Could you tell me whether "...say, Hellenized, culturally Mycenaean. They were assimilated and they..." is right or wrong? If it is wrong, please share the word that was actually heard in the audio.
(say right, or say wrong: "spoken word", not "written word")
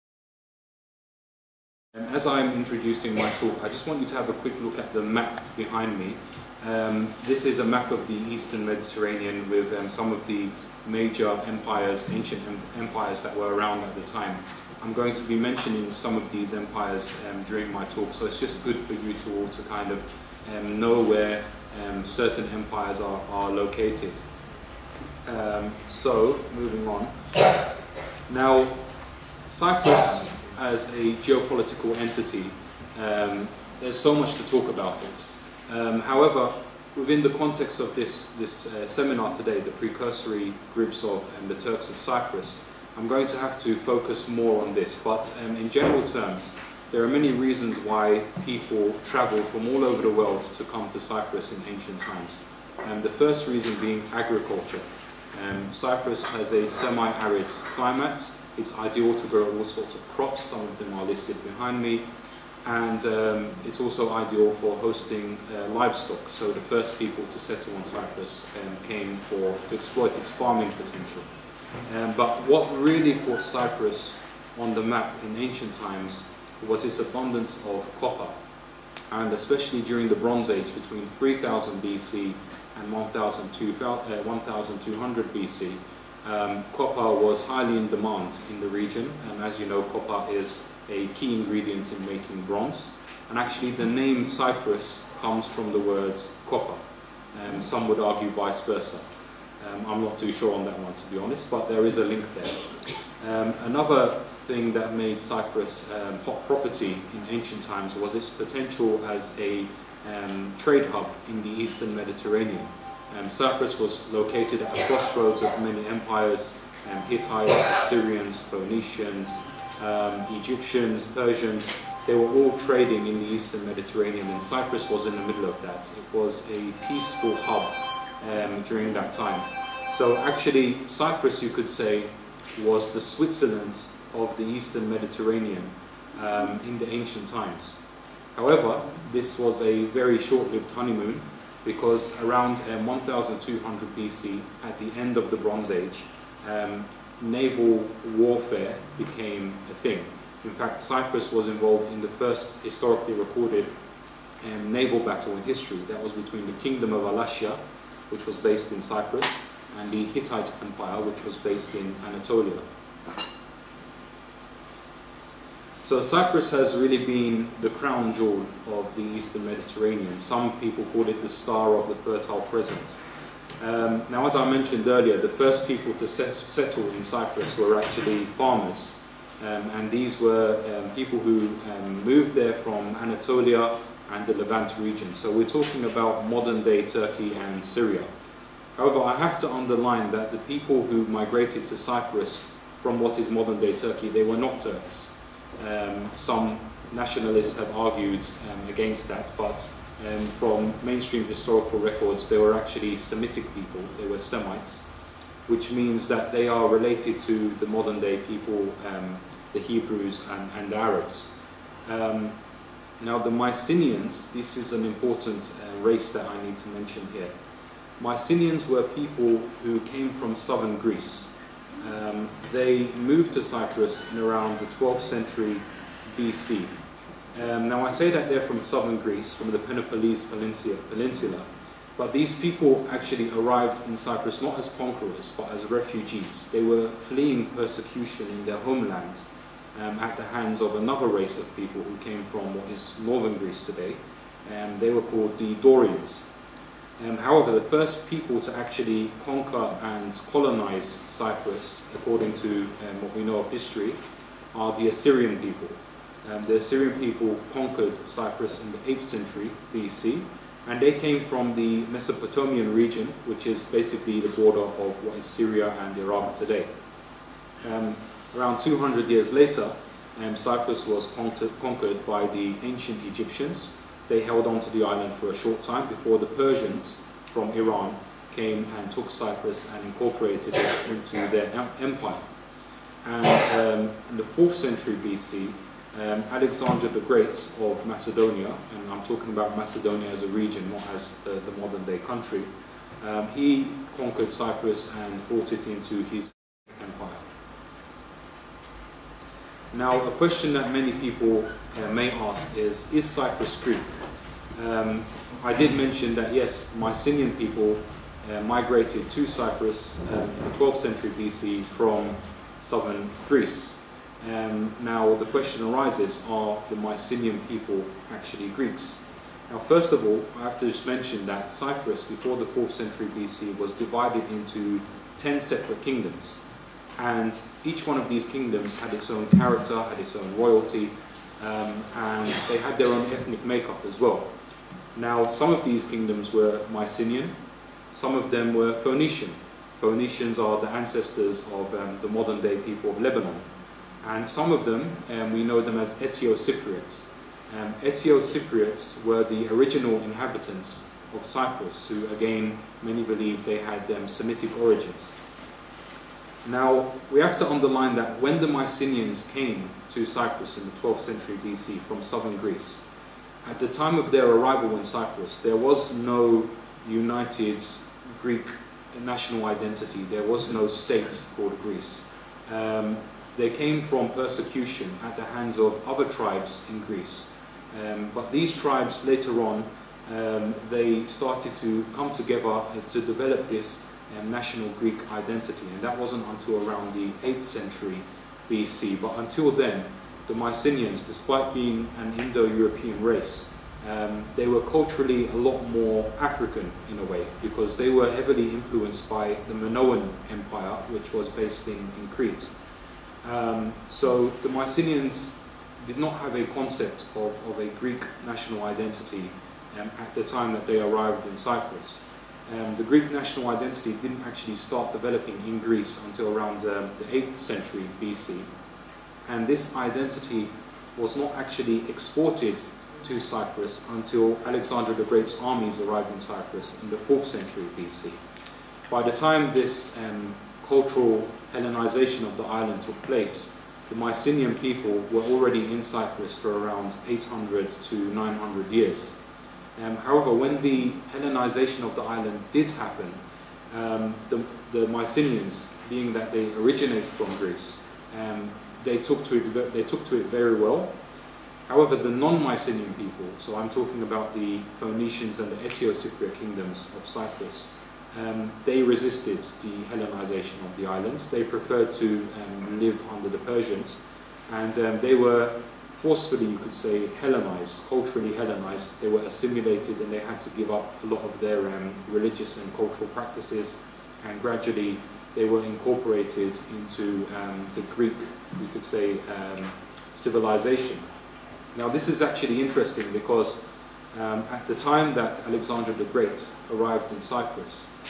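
wrong: "Hellenized", not "Mycenaean".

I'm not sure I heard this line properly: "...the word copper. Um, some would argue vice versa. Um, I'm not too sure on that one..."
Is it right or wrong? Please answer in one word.
right.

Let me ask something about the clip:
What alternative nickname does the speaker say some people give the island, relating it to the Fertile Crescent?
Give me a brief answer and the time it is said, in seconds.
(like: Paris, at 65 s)
the star of the Fertile Crescent, at 171 s.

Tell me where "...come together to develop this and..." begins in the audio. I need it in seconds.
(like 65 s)
381 s.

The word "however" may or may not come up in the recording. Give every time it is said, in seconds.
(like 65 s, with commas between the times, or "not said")
36 s, 138 s, 188 s, 247 s, 439 s, 451 s.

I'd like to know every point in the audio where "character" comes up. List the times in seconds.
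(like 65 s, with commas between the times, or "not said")
329 s.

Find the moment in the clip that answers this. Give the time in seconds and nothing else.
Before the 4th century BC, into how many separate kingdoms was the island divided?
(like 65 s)
325 s.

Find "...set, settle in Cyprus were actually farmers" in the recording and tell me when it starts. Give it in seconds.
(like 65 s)
176 s.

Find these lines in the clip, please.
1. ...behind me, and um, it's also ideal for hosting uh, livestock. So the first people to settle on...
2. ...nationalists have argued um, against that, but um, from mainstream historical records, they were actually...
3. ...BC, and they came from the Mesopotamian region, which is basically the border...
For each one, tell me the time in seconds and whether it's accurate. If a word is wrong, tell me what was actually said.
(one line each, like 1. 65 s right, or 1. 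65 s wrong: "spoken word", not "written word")
1. 61 s right
2. 196 s right
3. 259 s right.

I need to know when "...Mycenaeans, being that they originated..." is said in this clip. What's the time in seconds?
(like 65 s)
444 s.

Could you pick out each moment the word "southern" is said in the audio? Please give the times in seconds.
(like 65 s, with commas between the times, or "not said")
220 s, 228 s, 312 s, 362 s.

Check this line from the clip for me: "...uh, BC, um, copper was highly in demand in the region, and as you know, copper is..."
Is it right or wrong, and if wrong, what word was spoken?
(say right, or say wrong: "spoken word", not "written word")
right.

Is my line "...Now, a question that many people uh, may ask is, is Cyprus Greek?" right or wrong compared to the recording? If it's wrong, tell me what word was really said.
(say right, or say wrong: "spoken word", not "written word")
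right.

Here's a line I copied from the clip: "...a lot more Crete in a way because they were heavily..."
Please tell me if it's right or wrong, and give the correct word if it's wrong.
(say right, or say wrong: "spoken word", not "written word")
wrong: "African", not "Crete".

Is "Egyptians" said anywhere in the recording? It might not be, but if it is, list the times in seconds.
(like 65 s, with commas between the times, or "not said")
120 s, 273 s.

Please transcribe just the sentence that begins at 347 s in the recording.
Um, Eteo-Cypriots were the original inhabitants of Cyprus, who again, many believe they had um, Semitic origins.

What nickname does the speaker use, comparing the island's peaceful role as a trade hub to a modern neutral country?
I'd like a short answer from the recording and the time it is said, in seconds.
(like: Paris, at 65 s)
the Switzerland of the eastern Mediterranean, at 133 s.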